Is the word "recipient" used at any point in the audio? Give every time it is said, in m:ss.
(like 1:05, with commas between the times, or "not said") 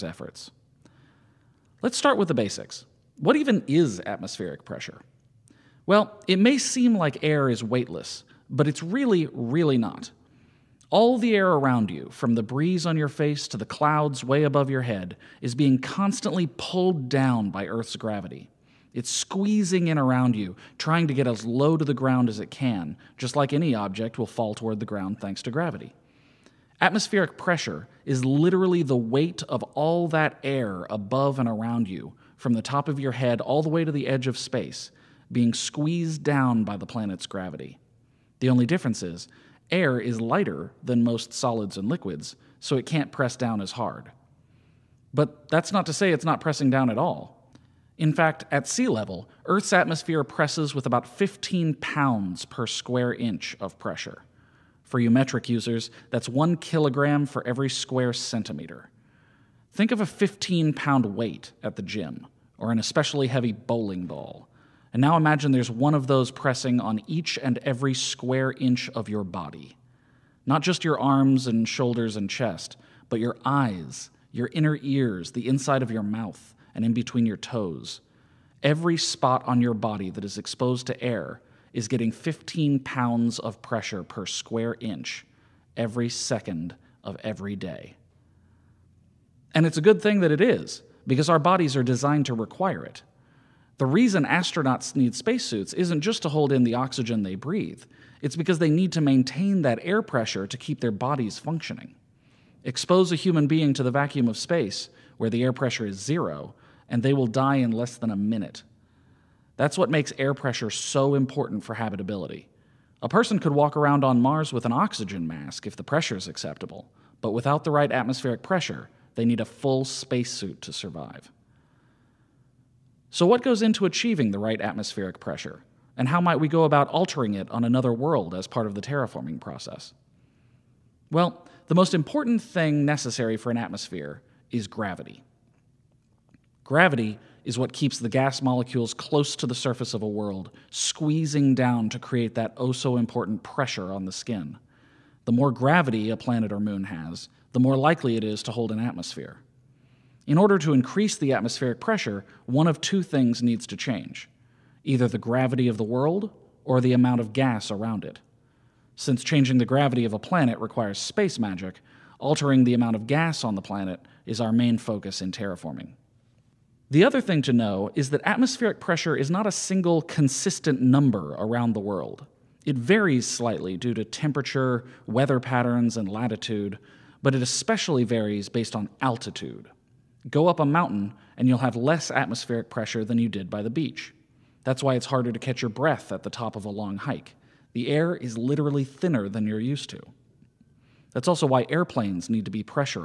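not said.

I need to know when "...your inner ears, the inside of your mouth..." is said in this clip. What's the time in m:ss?
1:14.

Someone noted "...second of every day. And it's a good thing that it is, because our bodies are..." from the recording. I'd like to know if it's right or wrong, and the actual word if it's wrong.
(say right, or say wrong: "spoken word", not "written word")
right.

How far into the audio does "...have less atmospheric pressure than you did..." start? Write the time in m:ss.
3:01.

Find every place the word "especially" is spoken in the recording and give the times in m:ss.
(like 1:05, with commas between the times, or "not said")
1:02, 2:57.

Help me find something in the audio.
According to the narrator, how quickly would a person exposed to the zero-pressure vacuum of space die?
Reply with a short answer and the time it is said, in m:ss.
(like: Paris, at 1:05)
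Less than a minute, at 1:47.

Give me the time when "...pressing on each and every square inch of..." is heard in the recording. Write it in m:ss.
1:06.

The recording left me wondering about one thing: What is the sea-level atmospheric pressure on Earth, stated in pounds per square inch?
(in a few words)
15 pounds per square inch.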